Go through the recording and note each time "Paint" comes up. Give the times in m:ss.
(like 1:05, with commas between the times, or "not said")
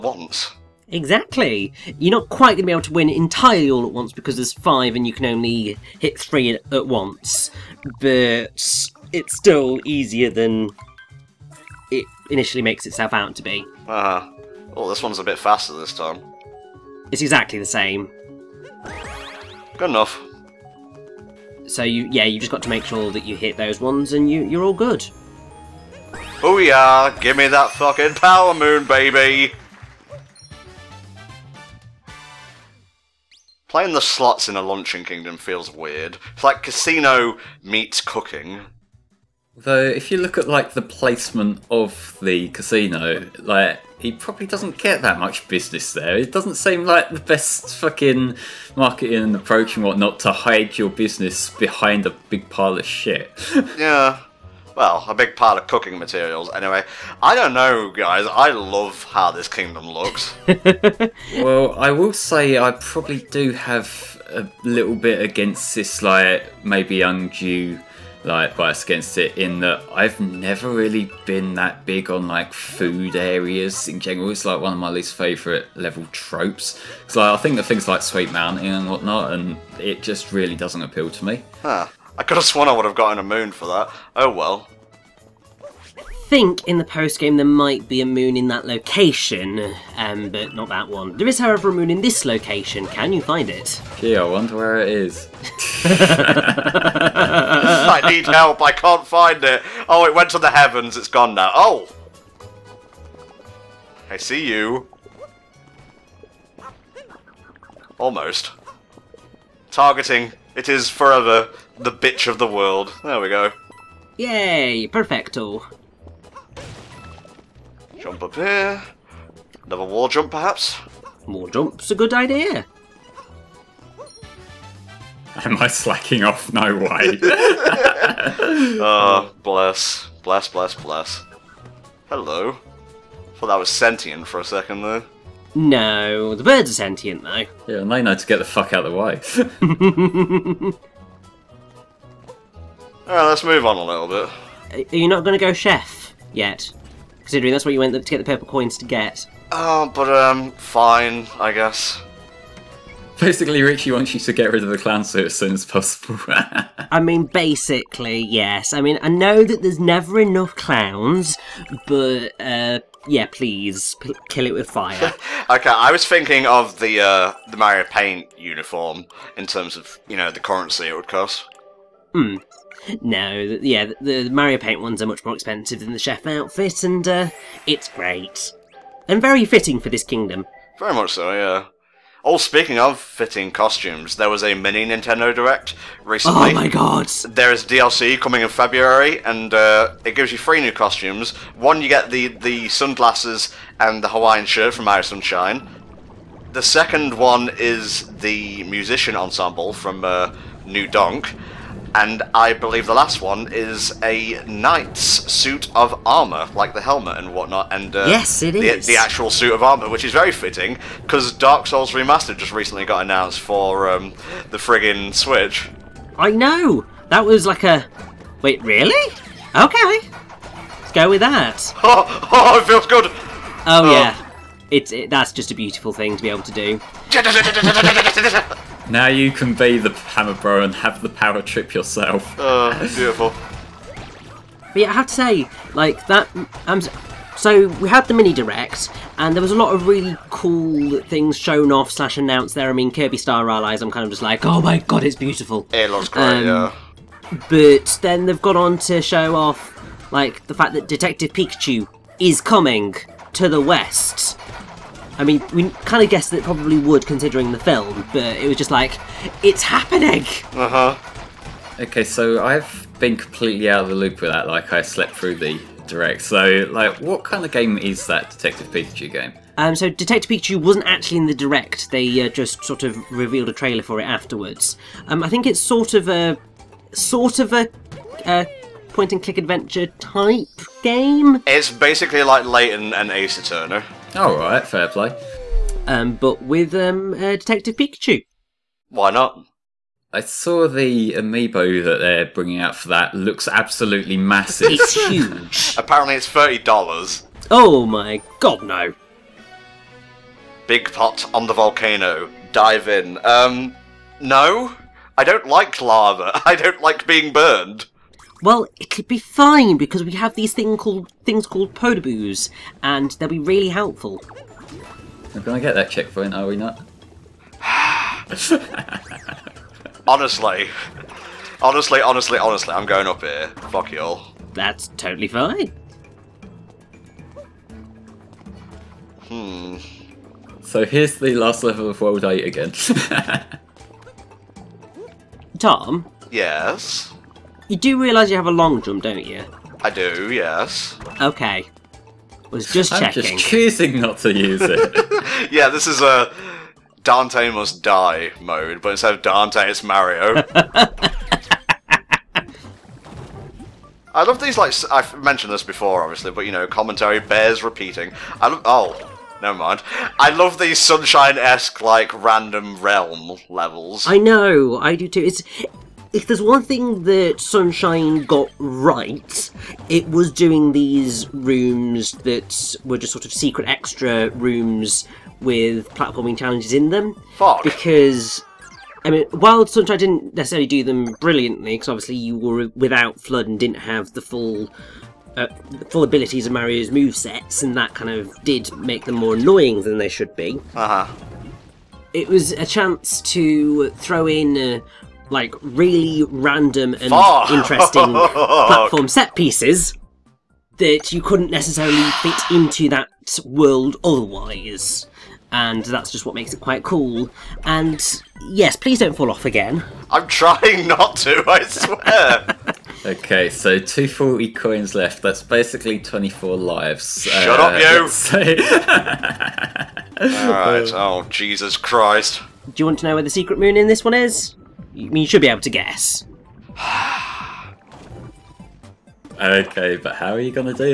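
2:47, 2:54.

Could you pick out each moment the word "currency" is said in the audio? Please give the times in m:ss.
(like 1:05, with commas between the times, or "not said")
2:50.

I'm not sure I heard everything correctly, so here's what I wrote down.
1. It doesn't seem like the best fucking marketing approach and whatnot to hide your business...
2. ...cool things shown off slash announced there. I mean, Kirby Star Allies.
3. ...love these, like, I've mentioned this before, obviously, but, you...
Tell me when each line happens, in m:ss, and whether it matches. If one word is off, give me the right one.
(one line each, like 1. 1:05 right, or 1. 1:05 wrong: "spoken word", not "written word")
1. 0:46 right
2. 4:00 right
3. 5:54 right.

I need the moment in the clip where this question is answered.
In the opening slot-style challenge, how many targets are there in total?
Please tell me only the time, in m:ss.
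0:04.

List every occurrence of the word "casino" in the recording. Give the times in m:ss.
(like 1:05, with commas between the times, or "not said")
0:36, 0:42.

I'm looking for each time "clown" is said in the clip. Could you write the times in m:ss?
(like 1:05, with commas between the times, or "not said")
2:34, 2:40.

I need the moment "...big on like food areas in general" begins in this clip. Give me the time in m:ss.
1:11.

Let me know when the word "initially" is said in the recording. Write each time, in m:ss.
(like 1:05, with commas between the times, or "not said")
0:12.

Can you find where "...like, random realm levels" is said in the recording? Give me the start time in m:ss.
6:01.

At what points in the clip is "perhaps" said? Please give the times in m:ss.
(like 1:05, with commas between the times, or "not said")
2:00.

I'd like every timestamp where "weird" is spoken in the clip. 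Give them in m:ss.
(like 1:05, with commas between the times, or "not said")
0:35.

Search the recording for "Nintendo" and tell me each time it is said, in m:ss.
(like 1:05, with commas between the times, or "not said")
3:04.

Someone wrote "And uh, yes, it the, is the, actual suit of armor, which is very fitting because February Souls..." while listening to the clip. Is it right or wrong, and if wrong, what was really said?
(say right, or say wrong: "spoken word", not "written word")
wrong: "Dark", not "February".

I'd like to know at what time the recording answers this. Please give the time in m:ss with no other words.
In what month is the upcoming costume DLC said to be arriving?
3:08.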